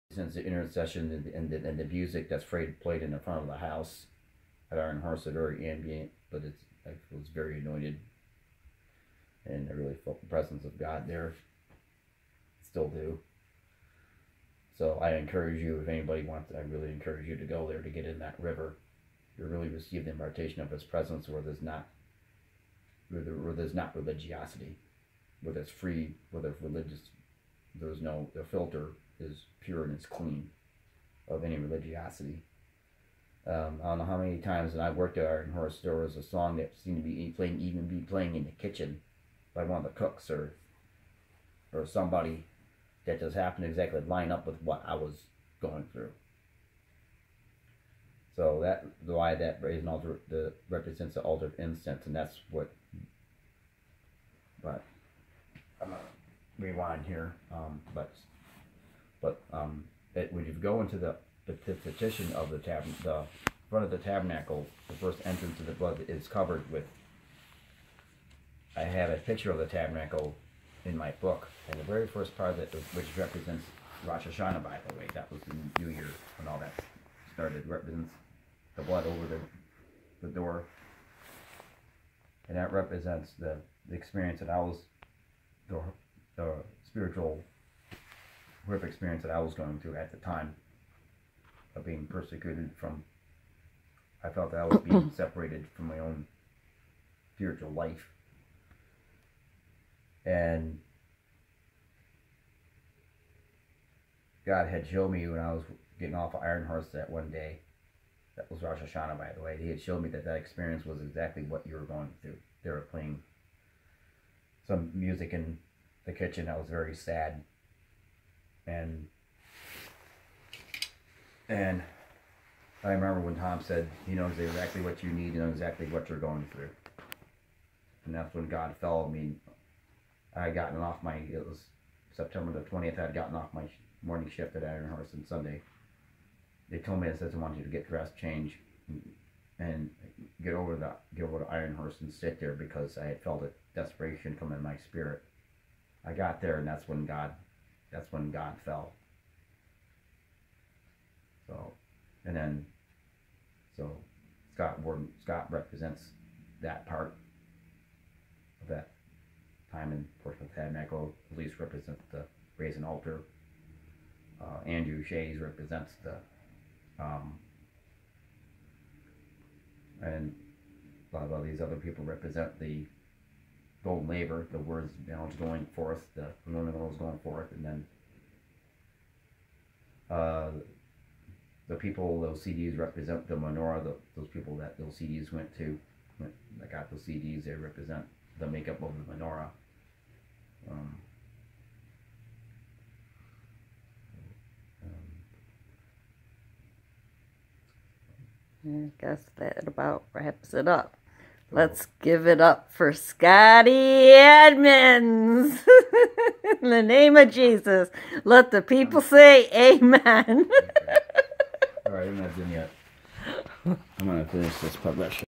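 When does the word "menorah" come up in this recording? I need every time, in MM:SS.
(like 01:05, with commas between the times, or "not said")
03:03, 03:09.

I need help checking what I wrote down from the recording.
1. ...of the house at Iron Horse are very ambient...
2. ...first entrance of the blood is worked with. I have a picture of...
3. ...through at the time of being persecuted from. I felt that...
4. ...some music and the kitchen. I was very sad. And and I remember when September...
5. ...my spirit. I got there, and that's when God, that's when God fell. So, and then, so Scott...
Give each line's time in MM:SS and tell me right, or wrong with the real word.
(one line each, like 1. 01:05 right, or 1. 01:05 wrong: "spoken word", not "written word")
1. 00:03 right
2. 01:04 wrong: "covered", not "worked"
3. 01:29 right
4. 01:54 wrong: "Tom", not "September"
5. 02:24 right.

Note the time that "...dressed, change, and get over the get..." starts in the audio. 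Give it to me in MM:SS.
02:17.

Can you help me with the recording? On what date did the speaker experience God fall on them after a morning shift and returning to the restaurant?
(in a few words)
September 20.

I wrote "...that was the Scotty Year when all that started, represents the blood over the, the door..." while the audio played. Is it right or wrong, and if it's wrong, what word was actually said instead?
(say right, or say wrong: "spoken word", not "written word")
wrong: "New", not "Scotty".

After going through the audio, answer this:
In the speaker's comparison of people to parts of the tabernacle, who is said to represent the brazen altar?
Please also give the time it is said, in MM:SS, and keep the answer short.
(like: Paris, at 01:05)
Elise, at 02:41.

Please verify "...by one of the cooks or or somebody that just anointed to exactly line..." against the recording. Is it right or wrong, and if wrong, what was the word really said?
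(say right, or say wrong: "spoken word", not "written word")
wrong: "happened", not "anointed".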